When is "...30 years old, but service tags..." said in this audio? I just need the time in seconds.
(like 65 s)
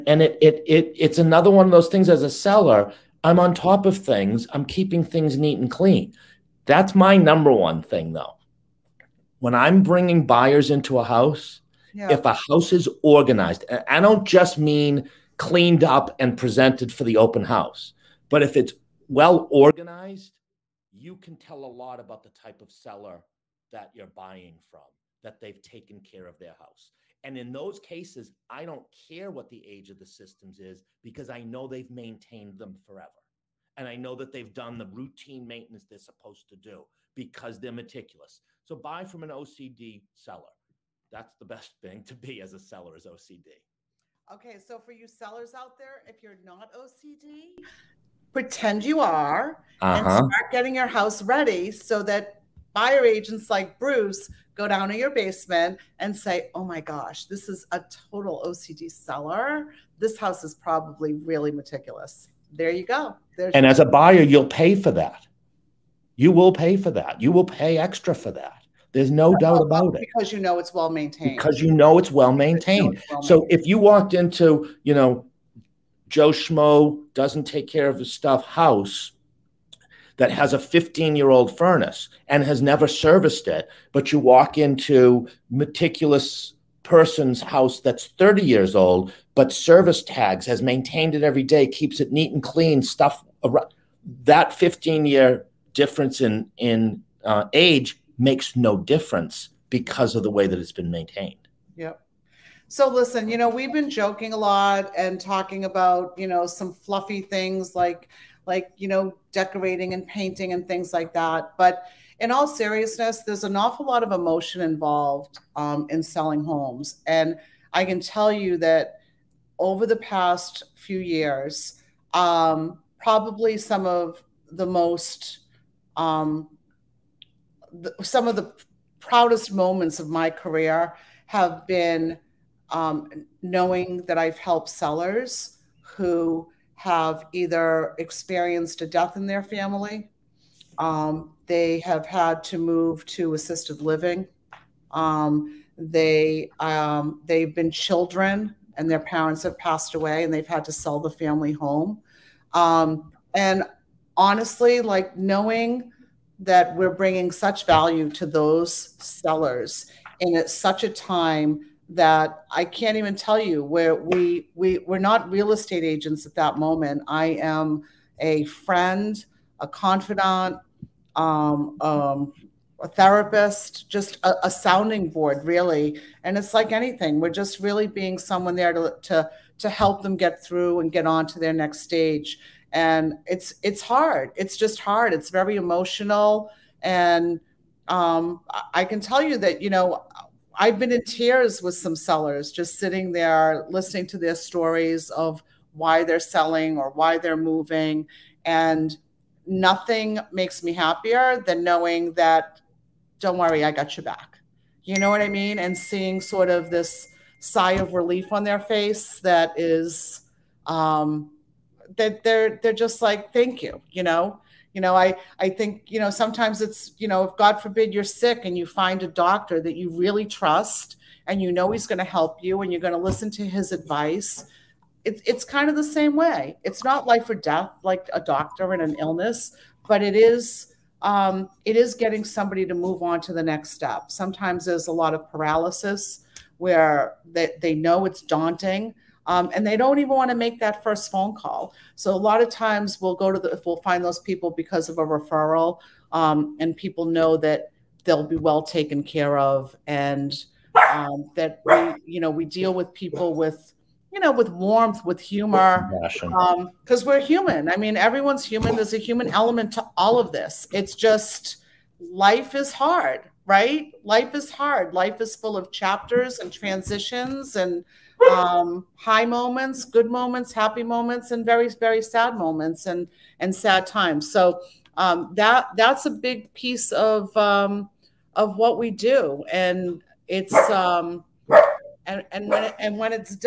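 88 s.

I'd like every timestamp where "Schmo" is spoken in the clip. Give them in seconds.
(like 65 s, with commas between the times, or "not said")
76 s.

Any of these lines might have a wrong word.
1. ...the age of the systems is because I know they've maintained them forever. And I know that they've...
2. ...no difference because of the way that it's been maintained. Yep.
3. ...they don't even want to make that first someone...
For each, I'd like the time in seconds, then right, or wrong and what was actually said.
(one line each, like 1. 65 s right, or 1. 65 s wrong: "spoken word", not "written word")
1. 29 s right
2. 98 s right
3. 239 s wrong: "phone", not "someone".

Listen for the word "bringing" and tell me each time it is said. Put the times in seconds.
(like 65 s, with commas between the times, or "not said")
9 s, 156 s.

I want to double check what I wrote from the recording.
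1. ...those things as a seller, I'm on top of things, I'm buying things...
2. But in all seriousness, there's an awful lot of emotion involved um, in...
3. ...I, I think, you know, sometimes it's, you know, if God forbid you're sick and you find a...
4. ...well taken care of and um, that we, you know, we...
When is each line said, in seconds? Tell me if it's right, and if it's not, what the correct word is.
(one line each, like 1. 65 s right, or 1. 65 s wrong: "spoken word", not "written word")
1. 1 s wrong: "keeping", not "buying"
2. 111 s right
3. 214 s right
4. 248 s right.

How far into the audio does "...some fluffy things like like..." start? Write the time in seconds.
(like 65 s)
106 s.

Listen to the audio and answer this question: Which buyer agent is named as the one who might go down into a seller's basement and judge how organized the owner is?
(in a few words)
Bruce.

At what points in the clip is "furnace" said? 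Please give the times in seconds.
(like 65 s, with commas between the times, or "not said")
81 s.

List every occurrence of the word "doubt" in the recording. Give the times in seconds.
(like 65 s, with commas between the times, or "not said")
69 s.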